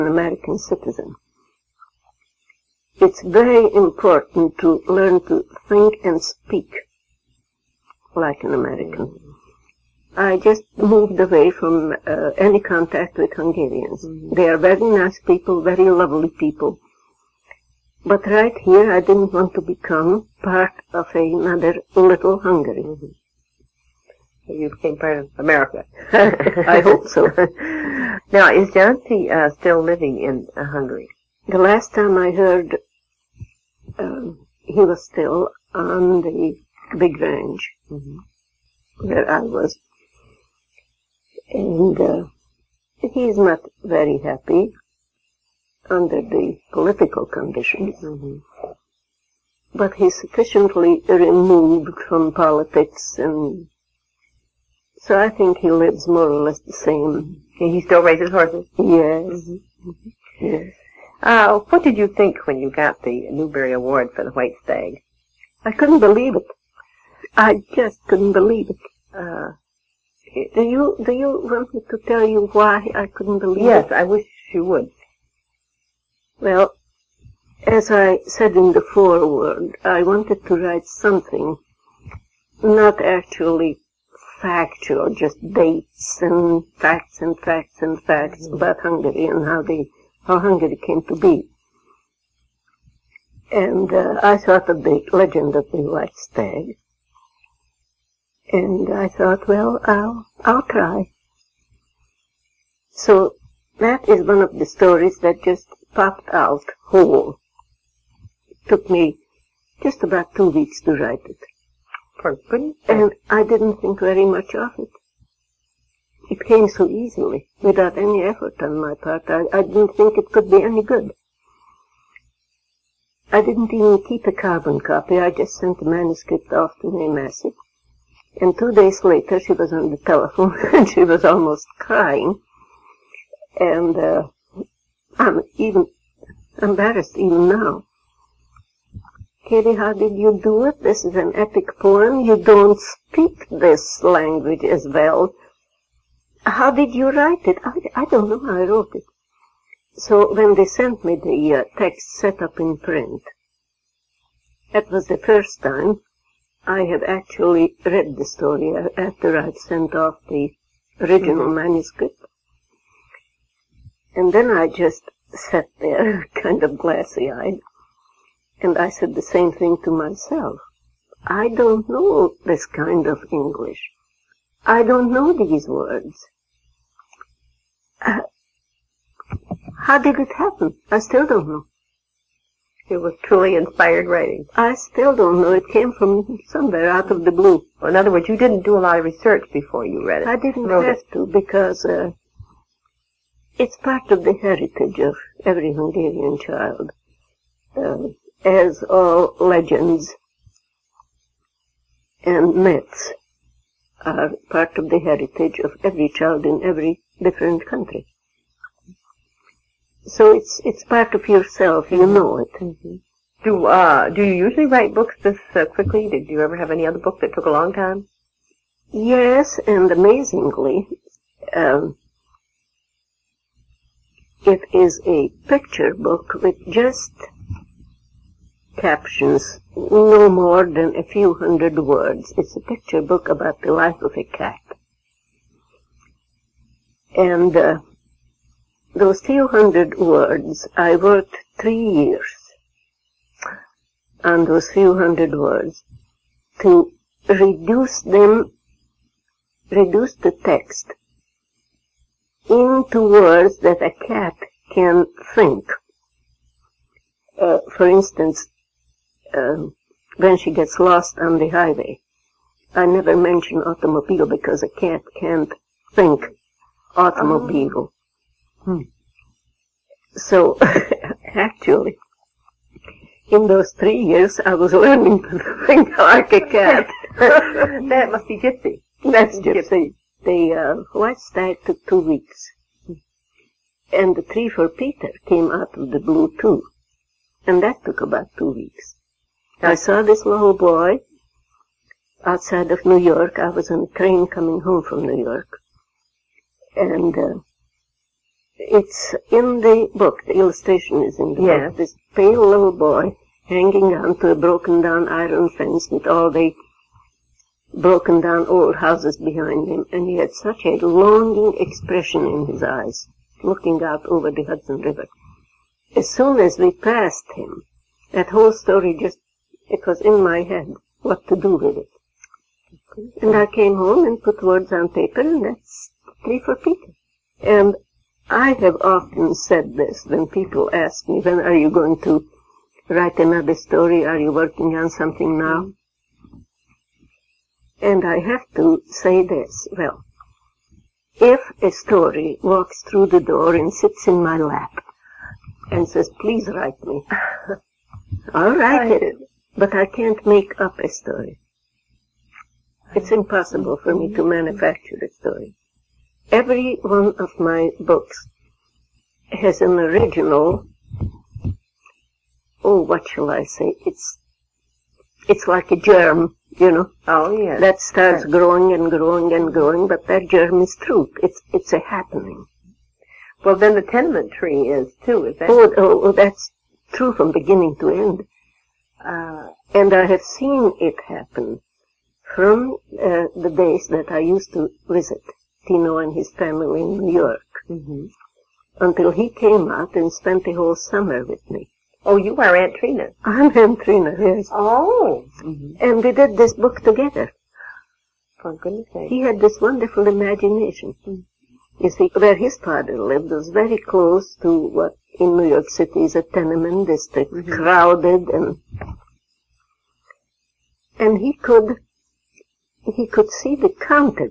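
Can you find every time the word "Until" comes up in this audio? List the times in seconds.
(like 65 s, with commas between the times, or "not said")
388 s.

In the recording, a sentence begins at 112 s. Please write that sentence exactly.
For And I didn't think very much of it.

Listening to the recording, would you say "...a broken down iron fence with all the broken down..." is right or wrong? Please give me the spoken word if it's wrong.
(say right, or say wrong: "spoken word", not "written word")
right.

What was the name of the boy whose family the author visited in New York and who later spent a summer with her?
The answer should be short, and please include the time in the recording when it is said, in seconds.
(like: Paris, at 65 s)
Tino, at 385 s.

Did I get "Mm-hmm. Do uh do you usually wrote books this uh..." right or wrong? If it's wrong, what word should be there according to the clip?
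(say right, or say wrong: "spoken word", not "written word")
wrong: "write", not "wrote".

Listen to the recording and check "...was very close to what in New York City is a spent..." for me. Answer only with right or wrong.
wrong.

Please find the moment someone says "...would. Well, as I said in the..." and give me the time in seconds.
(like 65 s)
74 s.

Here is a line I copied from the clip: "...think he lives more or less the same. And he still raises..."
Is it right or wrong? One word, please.
right.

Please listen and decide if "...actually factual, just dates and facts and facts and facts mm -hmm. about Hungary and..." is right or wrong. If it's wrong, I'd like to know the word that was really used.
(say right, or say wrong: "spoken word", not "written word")
right.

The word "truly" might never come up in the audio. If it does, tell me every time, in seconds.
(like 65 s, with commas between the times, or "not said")
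183 s.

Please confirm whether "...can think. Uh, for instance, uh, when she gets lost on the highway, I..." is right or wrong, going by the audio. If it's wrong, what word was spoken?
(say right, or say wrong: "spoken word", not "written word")
right.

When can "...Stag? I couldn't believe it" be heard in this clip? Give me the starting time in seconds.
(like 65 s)
64 s.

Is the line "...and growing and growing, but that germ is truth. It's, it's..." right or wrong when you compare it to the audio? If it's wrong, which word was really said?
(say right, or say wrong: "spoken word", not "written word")
right.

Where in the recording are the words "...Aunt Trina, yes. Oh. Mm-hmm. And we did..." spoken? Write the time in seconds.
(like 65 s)
393 s.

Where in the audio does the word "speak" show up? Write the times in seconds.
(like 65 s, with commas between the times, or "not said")
6 s, 142 s.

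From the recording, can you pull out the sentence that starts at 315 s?
As soon as we passed him, that whole story just it was in my head what to do with it.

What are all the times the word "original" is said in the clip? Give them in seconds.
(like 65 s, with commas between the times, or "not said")
161 s, 359 s.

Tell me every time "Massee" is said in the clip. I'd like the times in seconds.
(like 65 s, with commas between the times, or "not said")
127 s.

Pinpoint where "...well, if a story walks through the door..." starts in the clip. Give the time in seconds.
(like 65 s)
339 s.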